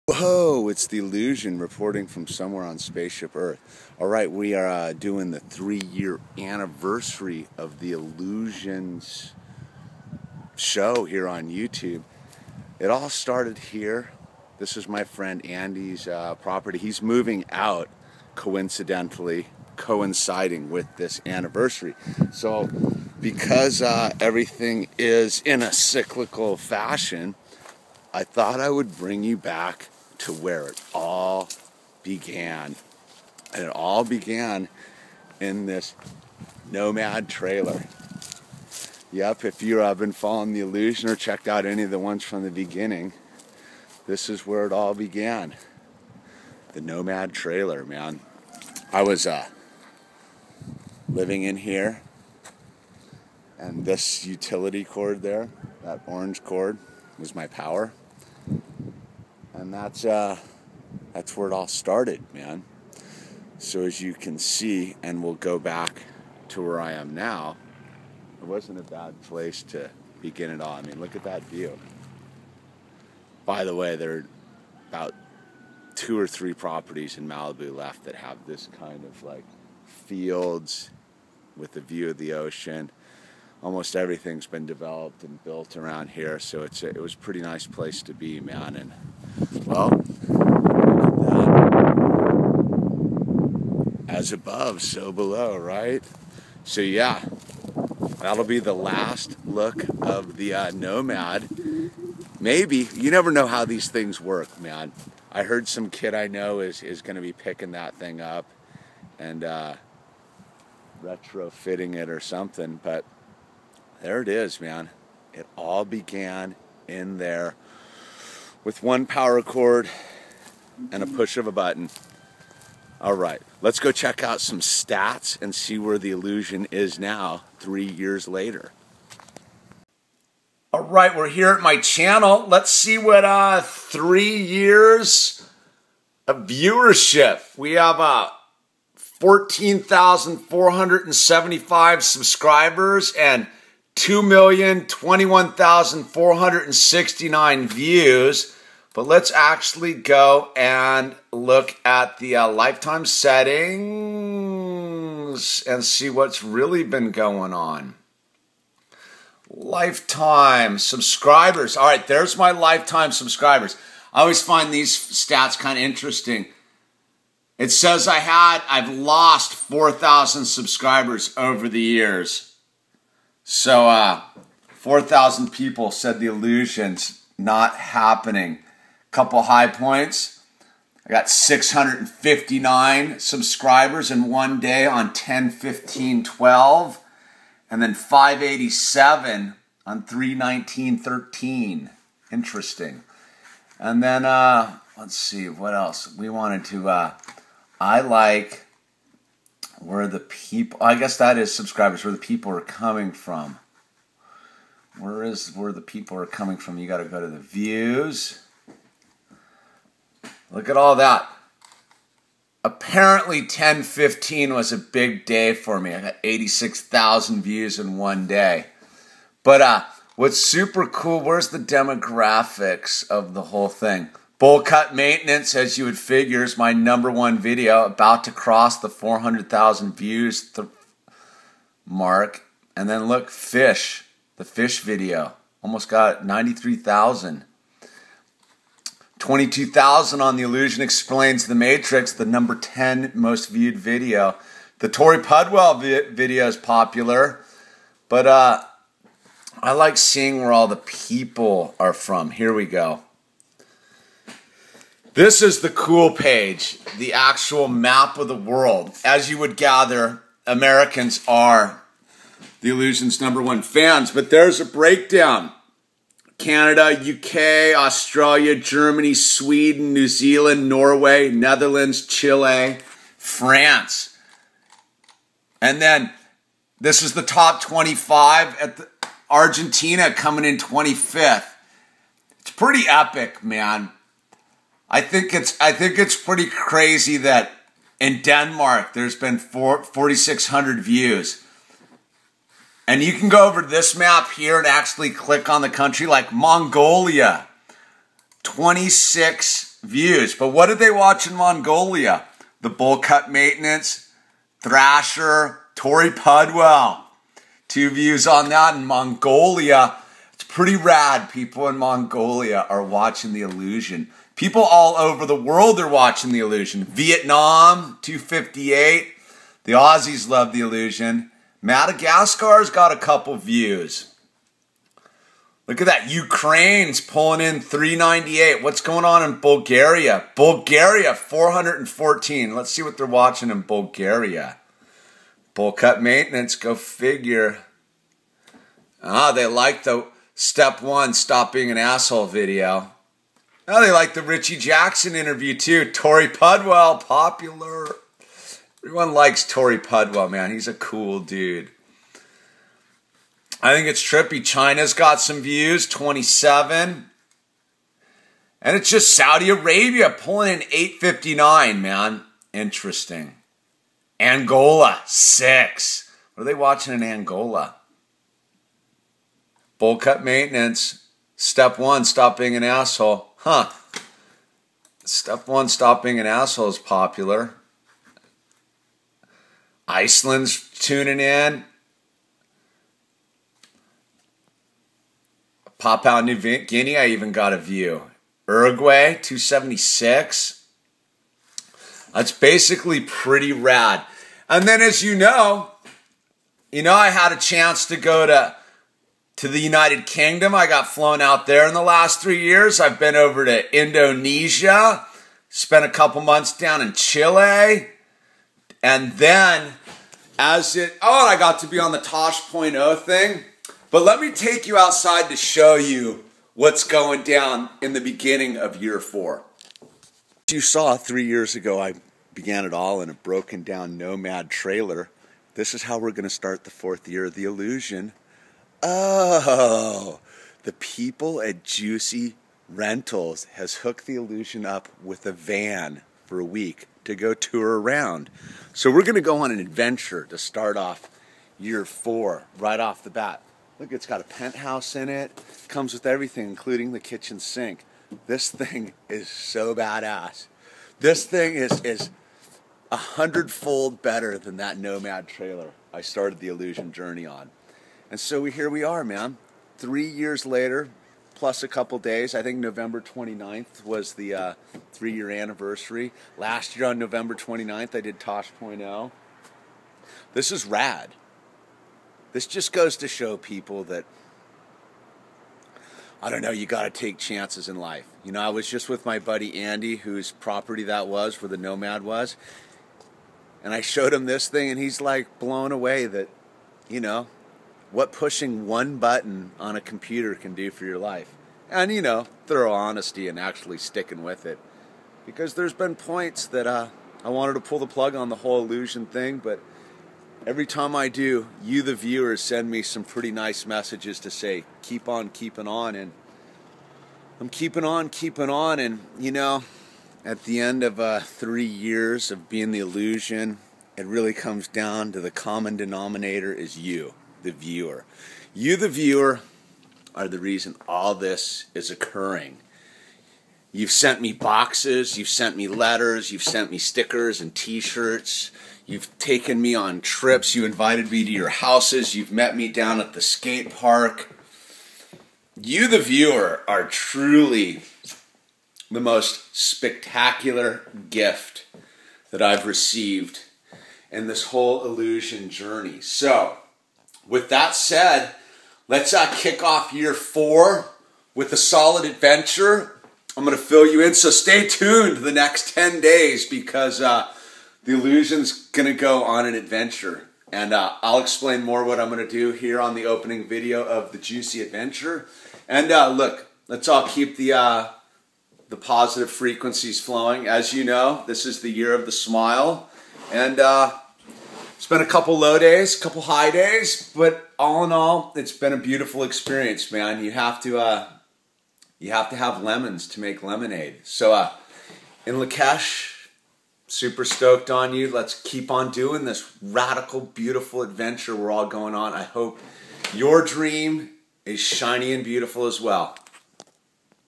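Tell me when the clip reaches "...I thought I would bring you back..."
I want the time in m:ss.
0:28.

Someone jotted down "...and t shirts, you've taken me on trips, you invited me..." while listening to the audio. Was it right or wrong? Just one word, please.
right.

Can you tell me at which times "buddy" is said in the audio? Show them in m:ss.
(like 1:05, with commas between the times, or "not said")
7:59.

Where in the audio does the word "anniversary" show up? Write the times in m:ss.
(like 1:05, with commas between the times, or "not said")
0:06, 0:21, 7:45.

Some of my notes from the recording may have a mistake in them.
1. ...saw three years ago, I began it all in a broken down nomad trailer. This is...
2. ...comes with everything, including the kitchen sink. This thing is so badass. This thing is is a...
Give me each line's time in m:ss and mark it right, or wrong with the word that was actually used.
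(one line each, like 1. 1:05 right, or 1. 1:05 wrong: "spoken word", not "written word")
1. 7:00 right
2. 7:25 right.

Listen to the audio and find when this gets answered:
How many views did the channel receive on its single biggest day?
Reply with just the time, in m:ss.
3:36.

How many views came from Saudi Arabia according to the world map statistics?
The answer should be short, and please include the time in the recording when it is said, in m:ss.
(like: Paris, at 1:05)
859, at 6:00.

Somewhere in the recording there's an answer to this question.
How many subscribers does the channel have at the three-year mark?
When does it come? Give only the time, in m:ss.
2:18.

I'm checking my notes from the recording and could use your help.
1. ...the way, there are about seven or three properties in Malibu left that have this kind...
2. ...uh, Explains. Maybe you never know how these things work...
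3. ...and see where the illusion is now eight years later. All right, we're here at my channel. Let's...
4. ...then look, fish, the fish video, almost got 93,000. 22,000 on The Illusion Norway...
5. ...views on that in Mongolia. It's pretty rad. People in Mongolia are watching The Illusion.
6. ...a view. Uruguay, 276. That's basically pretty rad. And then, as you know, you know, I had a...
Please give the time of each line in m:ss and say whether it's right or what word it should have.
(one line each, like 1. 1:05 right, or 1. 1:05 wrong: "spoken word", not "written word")
1. 1:13 wrong: "two", not "seven"
2. 1:40 wrong: "Nomad", not "Explains"
3. 2:05 wrong: "three", not "eight"
4. 3:52 wrong: "Explains", not "Norway"
5. 5:07 right
6. 6:27 right.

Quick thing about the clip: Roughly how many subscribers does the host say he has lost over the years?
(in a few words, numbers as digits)
4,000.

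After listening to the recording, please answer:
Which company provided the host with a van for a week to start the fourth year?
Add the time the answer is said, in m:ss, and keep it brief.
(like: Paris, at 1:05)
JUCY Rentals, at 7:11.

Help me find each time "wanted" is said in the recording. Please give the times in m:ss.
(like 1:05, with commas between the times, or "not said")
3:16, 8:17.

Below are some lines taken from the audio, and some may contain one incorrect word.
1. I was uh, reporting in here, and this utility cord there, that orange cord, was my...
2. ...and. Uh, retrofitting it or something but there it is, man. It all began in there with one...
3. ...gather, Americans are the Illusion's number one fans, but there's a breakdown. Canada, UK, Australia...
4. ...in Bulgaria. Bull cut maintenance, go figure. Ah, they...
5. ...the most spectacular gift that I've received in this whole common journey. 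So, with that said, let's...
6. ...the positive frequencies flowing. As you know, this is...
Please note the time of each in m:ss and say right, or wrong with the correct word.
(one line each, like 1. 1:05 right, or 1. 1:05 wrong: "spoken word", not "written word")
1. 0:48 wrong: "living", not "reporting"
2. 1:49 right
3. 4:19 right
4. 5:33 right
5. 8:58 wrong: "illusion", not "common"
6. 9:28 right.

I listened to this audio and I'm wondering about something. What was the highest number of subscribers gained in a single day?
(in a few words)
659.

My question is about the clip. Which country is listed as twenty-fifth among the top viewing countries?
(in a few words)
Argentina.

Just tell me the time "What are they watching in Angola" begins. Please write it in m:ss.
6:06.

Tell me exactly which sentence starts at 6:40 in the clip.
I got flown out there in the last three years.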